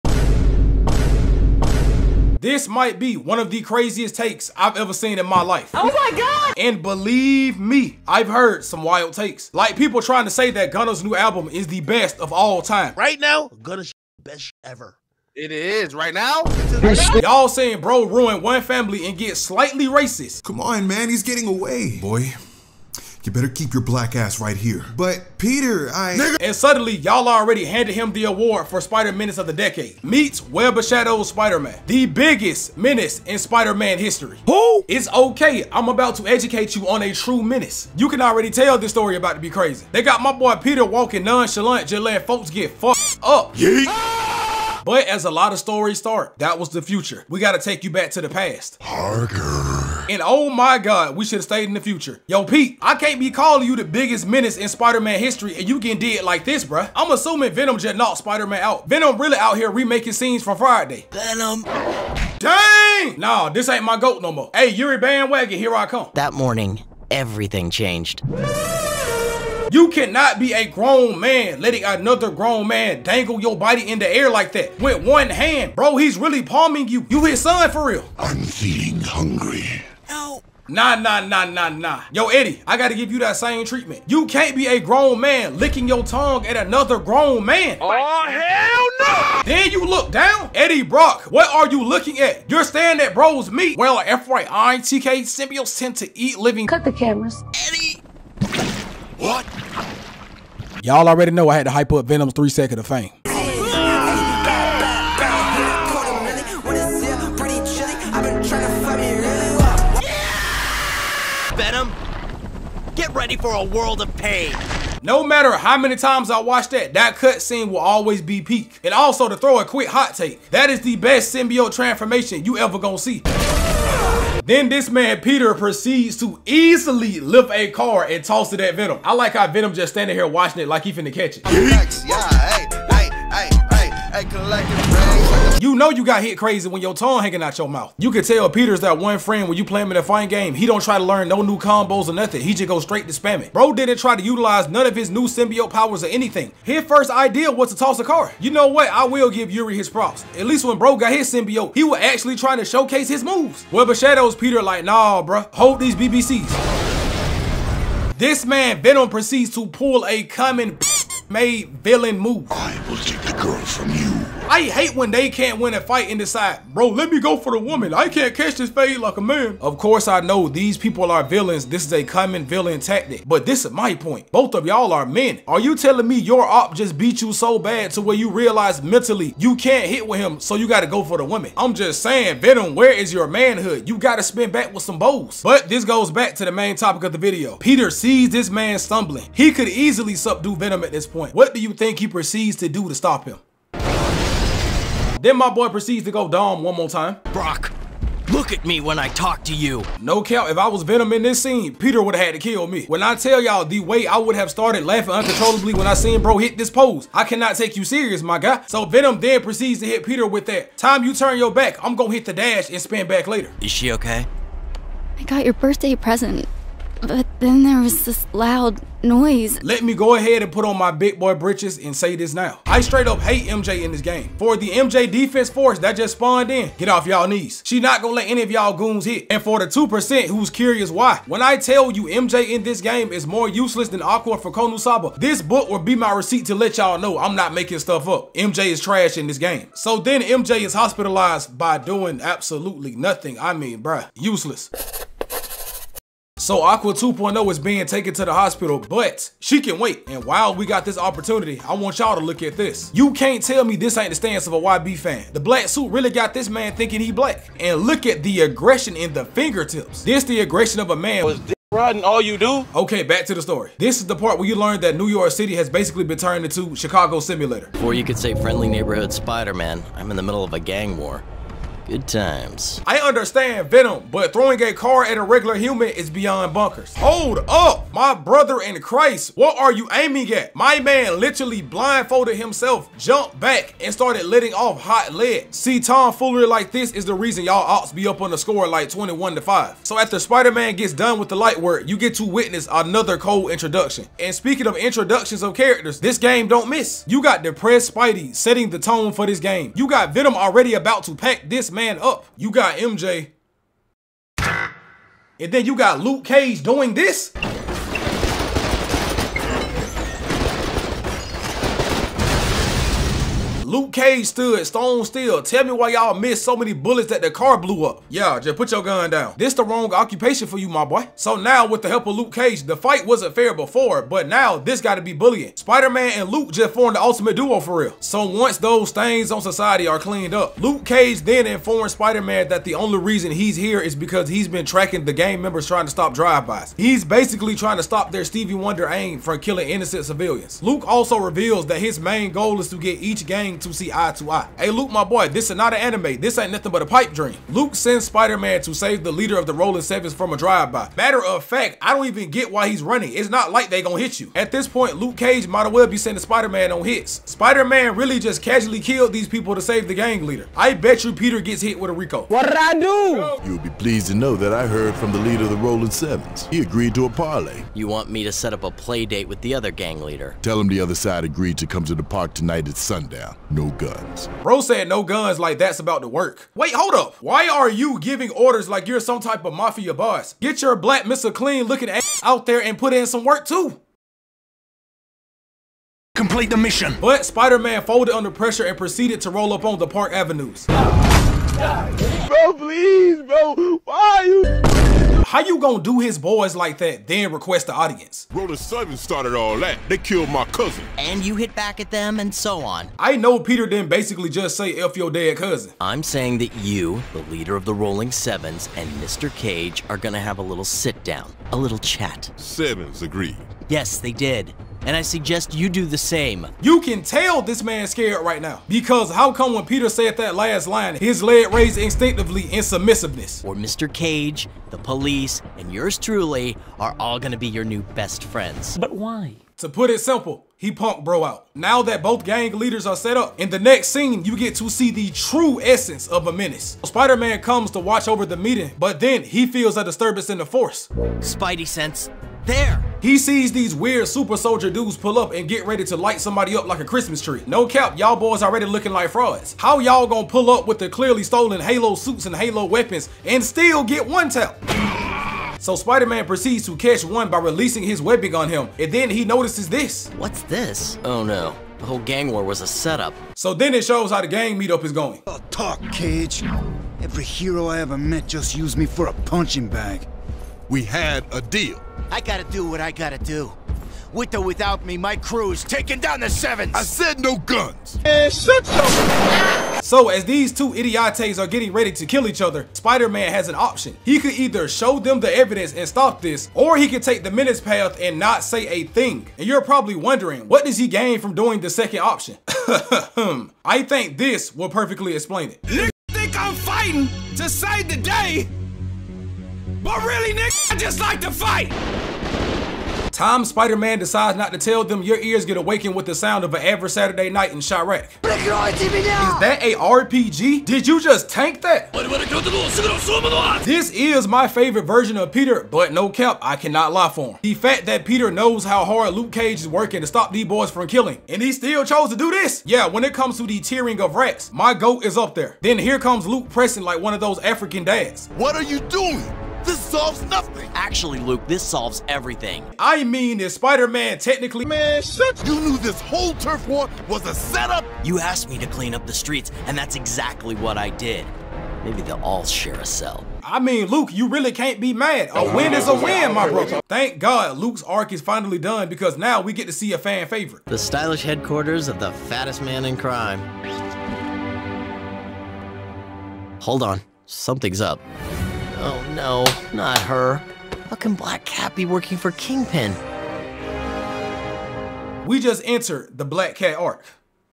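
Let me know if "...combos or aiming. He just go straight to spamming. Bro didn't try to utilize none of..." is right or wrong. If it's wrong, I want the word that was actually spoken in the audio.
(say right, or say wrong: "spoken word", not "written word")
wrong: "nothing", not "aiming".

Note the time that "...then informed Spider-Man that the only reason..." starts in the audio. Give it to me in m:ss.
5:31.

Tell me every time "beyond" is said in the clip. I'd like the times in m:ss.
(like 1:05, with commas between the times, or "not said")
4:36.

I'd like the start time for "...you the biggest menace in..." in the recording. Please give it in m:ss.
0:53.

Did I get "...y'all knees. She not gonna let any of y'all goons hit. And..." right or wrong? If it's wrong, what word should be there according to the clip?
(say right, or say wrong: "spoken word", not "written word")
right.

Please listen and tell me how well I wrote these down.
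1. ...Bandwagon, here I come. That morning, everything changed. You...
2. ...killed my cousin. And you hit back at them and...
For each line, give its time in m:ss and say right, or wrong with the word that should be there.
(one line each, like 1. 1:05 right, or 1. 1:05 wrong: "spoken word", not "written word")
1. 1:04 right
2. 6:39 right.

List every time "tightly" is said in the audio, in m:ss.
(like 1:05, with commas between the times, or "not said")
not said.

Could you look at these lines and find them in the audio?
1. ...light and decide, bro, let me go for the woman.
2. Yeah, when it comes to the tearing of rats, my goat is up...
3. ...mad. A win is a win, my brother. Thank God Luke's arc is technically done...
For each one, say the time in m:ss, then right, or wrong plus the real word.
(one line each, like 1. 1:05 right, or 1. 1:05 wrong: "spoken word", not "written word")
1. 2:45 wrong: "fight", not "light"
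2. 8:42 right
3. 9:04 wrong: "finally", not "technically".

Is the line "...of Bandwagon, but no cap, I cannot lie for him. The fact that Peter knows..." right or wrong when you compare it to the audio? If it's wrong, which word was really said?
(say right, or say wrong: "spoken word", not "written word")
wrong: "Peter", not "Bandwagon".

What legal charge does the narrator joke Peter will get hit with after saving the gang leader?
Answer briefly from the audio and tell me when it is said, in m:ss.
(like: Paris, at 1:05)
RICO, at 6:01.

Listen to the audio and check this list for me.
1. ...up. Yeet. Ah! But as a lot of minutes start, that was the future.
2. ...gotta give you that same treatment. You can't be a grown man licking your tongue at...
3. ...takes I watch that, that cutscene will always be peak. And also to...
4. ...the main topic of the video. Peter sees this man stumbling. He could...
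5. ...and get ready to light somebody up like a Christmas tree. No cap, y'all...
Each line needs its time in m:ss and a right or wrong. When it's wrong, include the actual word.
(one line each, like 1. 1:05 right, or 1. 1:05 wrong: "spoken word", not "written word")
1. 0:43 wrong: "stories", not "minutes"
2. 1:22 right
3. 1:55 wrong: "times", not "takes"
4. 3:06 right
5. 7:25 right.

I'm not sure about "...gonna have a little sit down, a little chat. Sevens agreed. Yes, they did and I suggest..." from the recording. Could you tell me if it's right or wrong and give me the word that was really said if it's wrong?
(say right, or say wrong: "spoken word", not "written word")
right.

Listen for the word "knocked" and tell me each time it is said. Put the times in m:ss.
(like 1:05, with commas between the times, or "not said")
0:57.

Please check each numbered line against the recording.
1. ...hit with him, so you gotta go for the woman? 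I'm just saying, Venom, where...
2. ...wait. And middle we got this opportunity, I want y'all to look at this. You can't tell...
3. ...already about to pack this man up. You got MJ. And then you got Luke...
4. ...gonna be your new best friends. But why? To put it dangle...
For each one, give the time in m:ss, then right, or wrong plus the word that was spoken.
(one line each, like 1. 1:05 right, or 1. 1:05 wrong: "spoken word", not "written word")
1. 2:59 right
2. 4:09 wrong: "while", not "middle"
3. 5:00 right
4. 7:07 wrong: "simple", not "dangle".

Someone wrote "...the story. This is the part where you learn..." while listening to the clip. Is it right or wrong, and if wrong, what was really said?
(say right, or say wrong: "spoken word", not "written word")
right.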